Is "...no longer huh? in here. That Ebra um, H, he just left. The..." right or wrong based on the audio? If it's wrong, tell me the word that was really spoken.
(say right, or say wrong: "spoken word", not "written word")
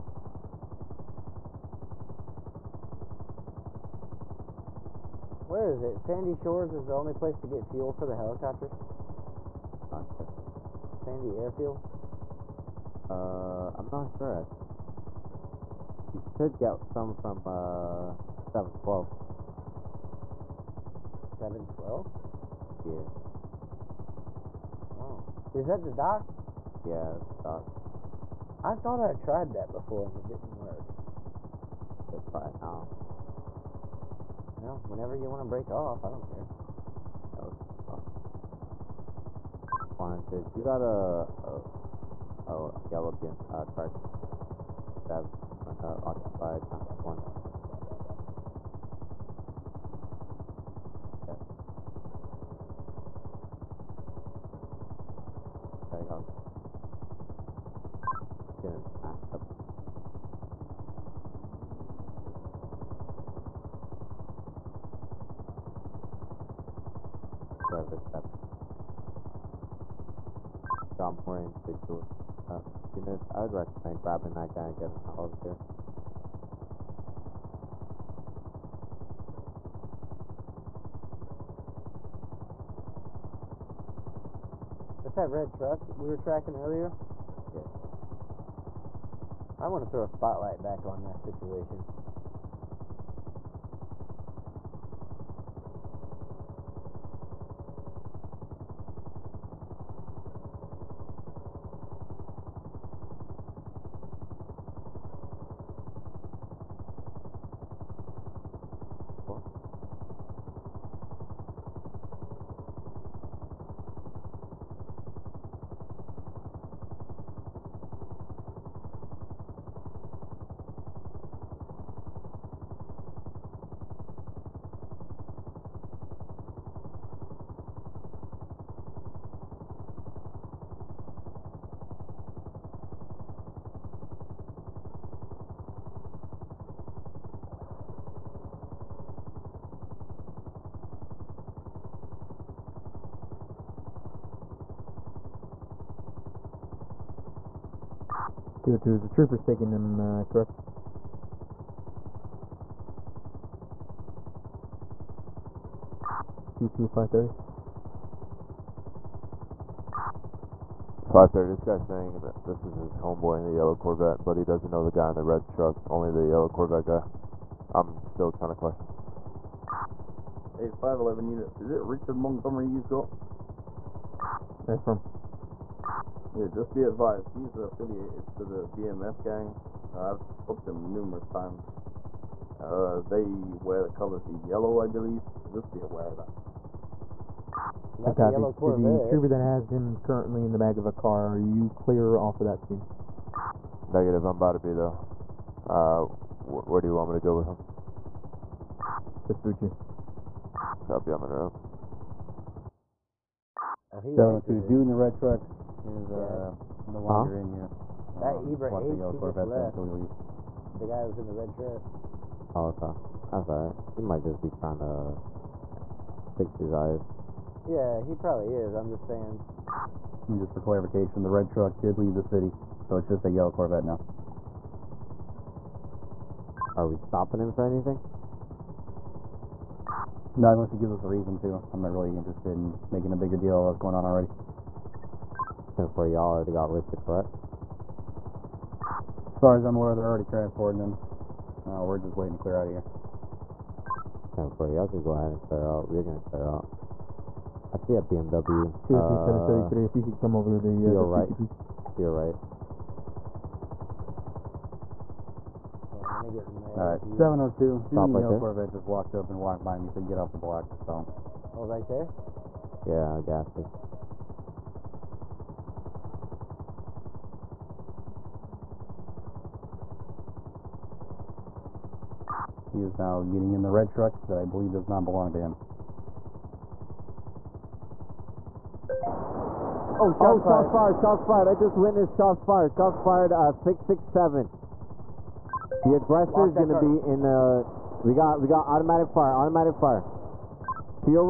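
right.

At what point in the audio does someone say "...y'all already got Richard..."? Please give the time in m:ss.
3:56.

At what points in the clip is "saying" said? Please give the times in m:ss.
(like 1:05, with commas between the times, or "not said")
2:41, 3:39.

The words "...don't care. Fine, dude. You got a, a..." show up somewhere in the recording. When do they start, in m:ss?
0:36.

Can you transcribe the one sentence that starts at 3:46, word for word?
Are we stopping him for anything?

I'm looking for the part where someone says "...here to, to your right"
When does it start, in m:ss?
4:10.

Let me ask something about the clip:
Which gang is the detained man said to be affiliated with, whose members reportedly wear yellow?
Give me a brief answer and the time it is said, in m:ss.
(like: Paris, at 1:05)
BMF, at 2:58.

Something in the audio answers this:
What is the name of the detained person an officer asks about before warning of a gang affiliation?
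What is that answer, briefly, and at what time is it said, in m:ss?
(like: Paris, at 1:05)
Richard Montgomery, at 2:51.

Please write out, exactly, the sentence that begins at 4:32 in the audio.
He is now getting in the red truck that I believe does not belong to him.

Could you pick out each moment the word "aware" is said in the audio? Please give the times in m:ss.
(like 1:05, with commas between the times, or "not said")
3:05, 3:59.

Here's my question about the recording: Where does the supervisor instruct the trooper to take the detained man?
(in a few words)
Vespucci.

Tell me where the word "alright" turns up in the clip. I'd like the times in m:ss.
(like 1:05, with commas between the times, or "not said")
3:33, 4:16.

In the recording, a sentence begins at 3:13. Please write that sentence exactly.
Negative, I'm about to be though.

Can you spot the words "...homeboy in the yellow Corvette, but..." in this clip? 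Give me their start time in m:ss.
2:42.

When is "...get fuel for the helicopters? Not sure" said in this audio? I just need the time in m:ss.
0:07.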